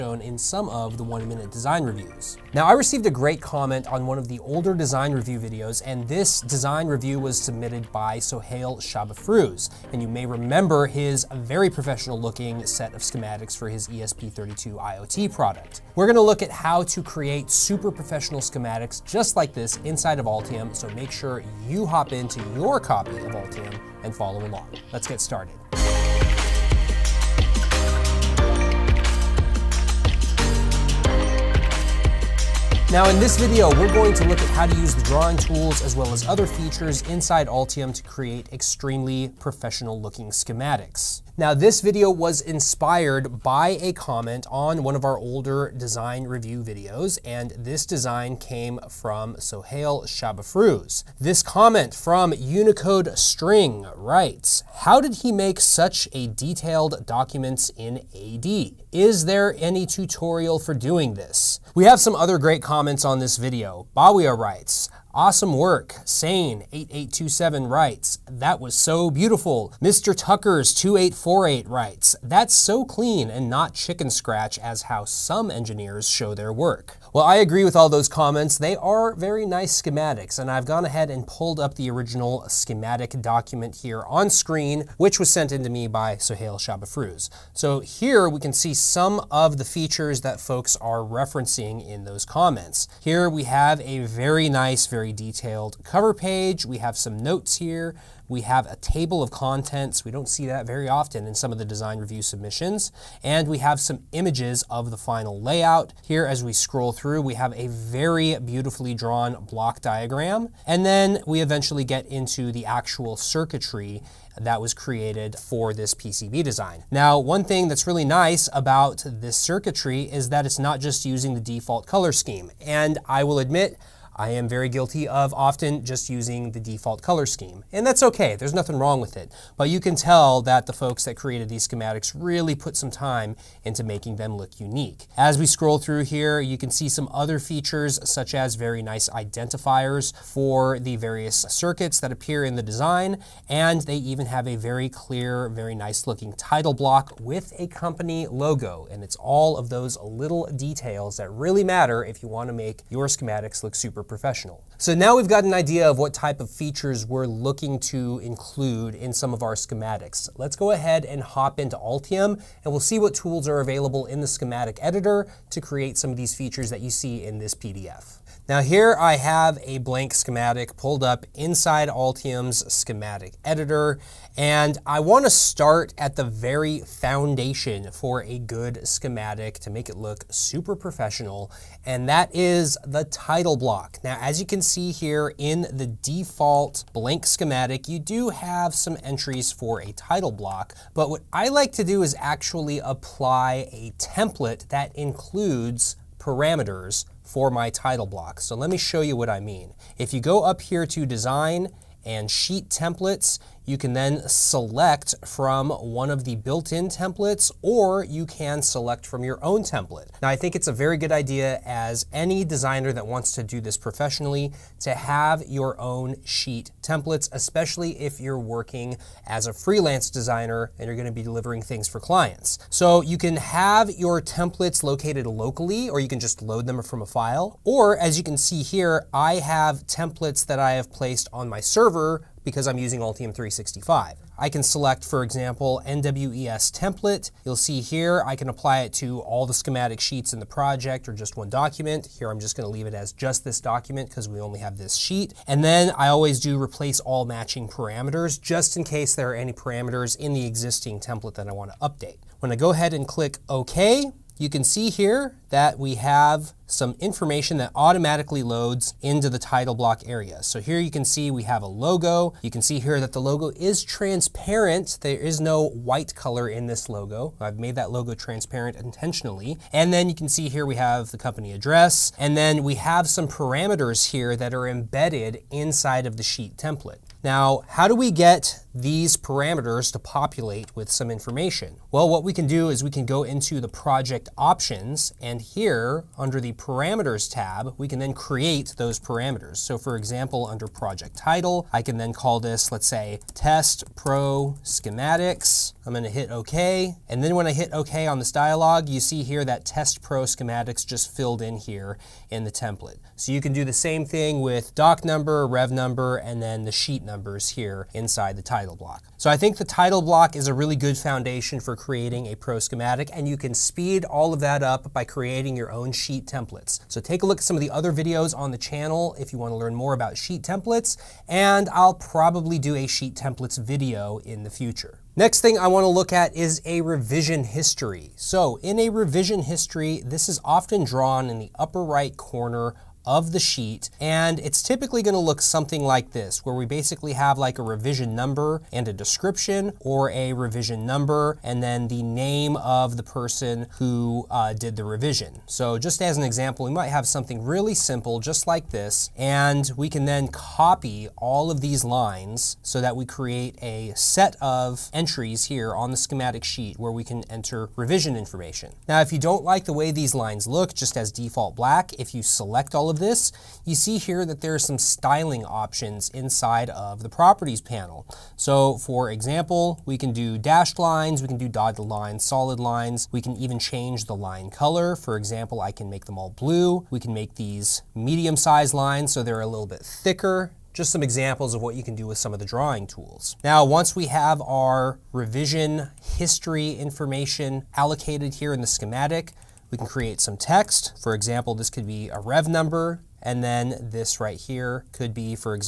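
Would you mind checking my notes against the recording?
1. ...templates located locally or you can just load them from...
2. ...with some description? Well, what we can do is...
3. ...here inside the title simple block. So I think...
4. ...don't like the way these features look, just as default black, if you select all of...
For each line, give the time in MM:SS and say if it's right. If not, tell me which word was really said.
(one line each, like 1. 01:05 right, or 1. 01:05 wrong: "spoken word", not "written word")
1. 03:44 right
2. 04:40 wrong: "information", not "description"
3. 05:07 wrong: "title", not "simple"
4. 05:59 wrong: "lines", not "features".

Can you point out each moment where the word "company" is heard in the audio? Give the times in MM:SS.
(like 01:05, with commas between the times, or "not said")
02:27, 04:31.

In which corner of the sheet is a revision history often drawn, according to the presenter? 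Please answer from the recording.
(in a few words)
upper right.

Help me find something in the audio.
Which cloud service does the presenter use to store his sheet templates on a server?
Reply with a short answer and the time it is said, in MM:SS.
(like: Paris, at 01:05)
Altium 365, at 03:53.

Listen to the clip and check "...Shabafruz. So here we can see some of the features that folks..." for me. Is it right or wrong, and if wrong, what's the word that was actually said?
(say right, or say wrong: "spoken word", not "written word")
right.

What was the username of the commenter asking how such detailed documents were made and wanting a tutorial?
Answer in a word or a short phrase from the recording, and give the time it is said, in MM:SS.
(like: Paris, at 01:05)
Unicode String, at 00:52.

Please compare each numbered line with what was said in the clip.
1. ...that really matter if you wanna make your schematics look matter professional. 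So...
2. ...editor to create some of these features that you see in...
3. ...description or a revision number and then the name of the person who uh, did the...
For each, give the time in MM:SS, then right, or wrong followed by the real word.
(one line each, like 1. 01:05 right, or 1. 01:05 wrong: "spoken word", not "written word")
1. 02:31 wrong: "super", not "matter"
2. 02:44 right
3. 05:38 right.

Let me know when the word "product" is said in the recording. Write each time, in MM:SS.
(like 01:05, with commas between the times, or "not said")
00:15.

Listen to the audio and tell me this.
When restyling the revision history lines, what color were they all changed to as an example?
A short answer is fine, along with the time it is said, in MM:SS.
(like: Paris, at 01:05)
blue, at 06:16.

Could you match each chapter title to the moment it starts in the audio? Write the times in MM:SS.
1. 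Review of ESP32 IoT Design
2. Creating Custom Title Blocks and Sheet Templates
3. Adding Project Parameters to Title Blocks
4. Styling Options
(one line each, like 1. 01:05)
1. 00:32
2. 02:34
3. 04:36
4. 05:58.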